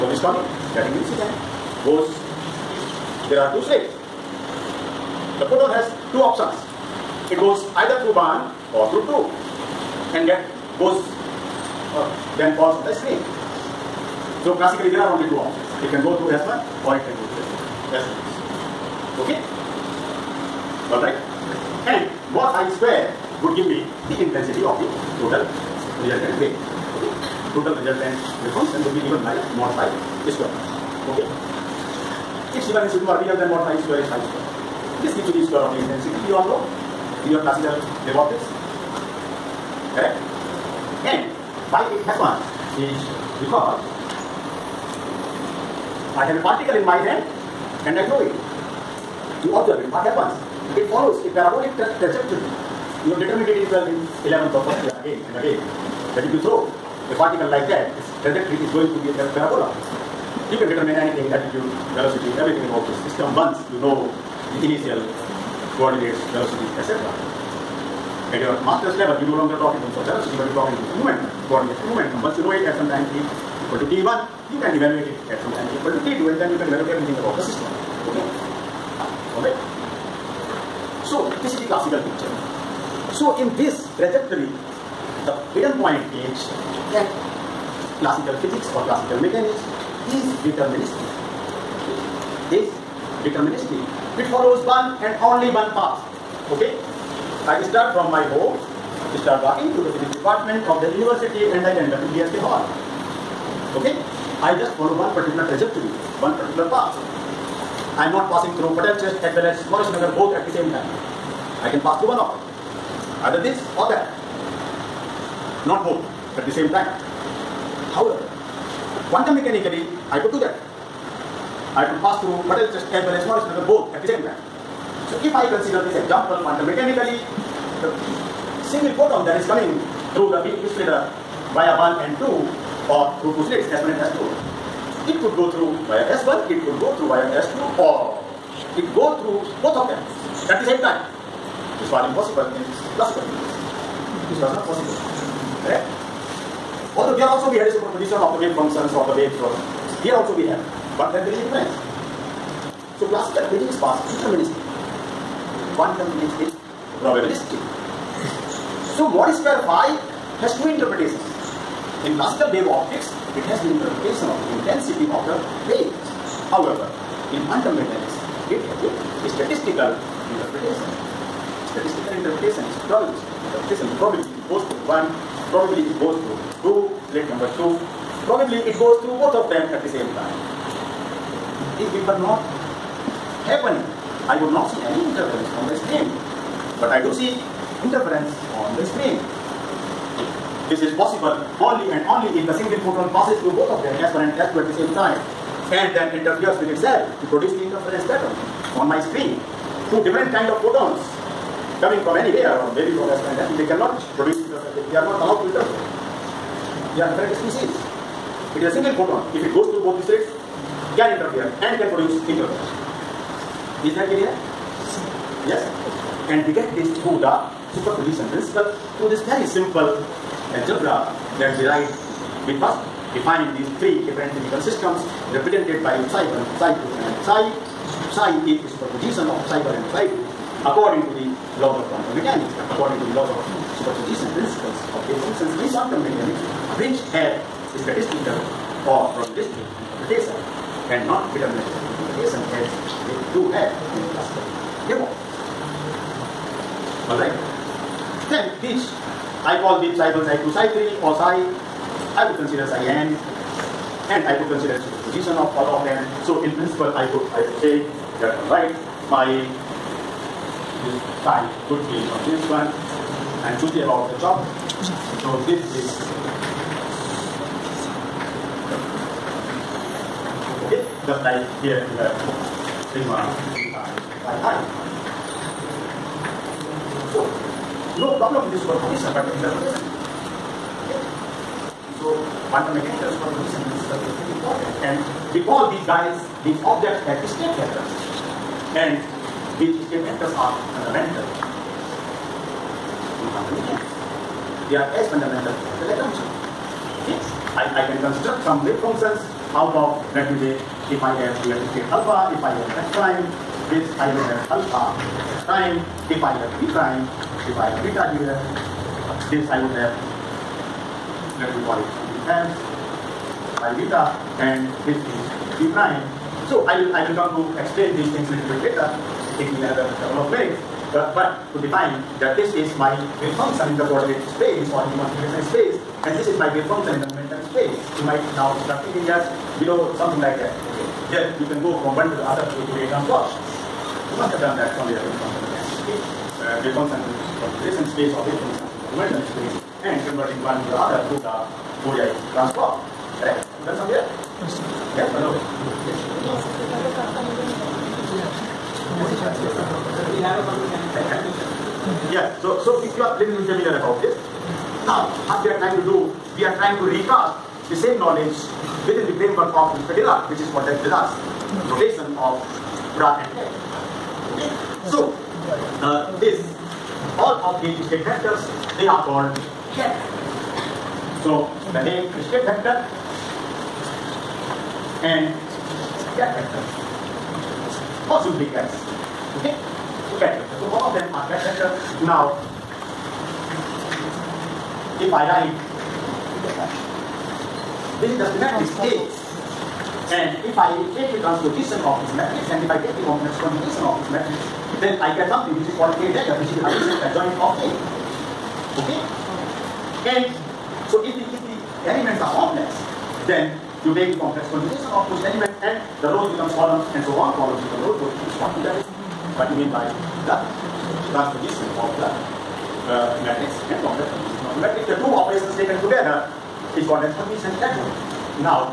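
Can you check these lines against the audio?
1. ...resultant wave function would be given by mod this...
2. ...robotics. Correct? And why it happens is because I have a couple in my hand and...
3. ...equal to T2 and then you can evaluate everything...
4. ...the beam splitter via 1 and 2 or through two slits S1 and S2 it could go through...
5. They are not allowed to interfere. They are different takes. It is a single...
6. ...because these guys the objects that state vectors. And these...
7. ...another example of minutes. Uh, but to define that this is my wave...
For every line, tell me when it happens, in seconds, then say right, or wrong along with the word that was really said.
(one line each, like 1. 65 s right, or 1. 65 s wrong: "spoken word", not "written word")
1. 27 s right
2. 38 s wrong: "particle", not "couple"
3. 75 s right
4. 130 s right
5. 204 s wrong: "species", not "takes"
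6. 285 s right
7. 319 s wrong: "couple", not "example".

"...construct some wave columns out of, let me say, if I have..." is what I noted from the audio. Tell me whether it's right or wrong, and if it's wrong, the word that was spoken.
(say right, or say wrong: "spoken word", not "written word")
wrong: "functions", not "columns".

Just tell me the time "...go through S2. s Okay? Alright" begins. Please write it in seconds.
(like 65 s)
17 s.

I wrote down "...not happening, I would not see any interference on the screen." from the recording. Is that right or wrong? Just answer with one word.
right.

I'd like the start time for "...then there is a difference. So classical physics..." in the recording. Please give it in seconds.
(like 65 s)
151 s.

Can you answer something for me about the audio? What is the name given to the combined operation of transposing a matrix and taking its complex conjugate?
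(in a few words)
Hermitian adjoint.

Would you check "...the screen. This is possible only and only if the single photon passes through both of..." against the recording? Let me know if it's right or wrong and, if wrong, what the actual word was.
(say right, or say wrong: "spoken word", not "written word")
right.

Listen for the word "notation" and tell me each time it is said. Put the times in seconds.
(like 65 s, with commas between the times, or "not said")
361 s.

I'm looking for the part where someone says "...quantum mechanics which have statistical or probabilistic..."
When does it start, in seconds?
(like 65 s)
235 s.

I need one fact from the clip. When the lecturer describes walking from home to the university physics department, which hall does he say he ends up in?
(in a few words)
DSP hall.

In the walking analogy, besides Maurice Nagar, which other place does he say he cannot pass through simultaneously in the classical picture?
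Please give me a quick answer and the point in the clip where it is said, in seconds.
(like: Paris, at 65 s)
Patel Chest, at 108 s.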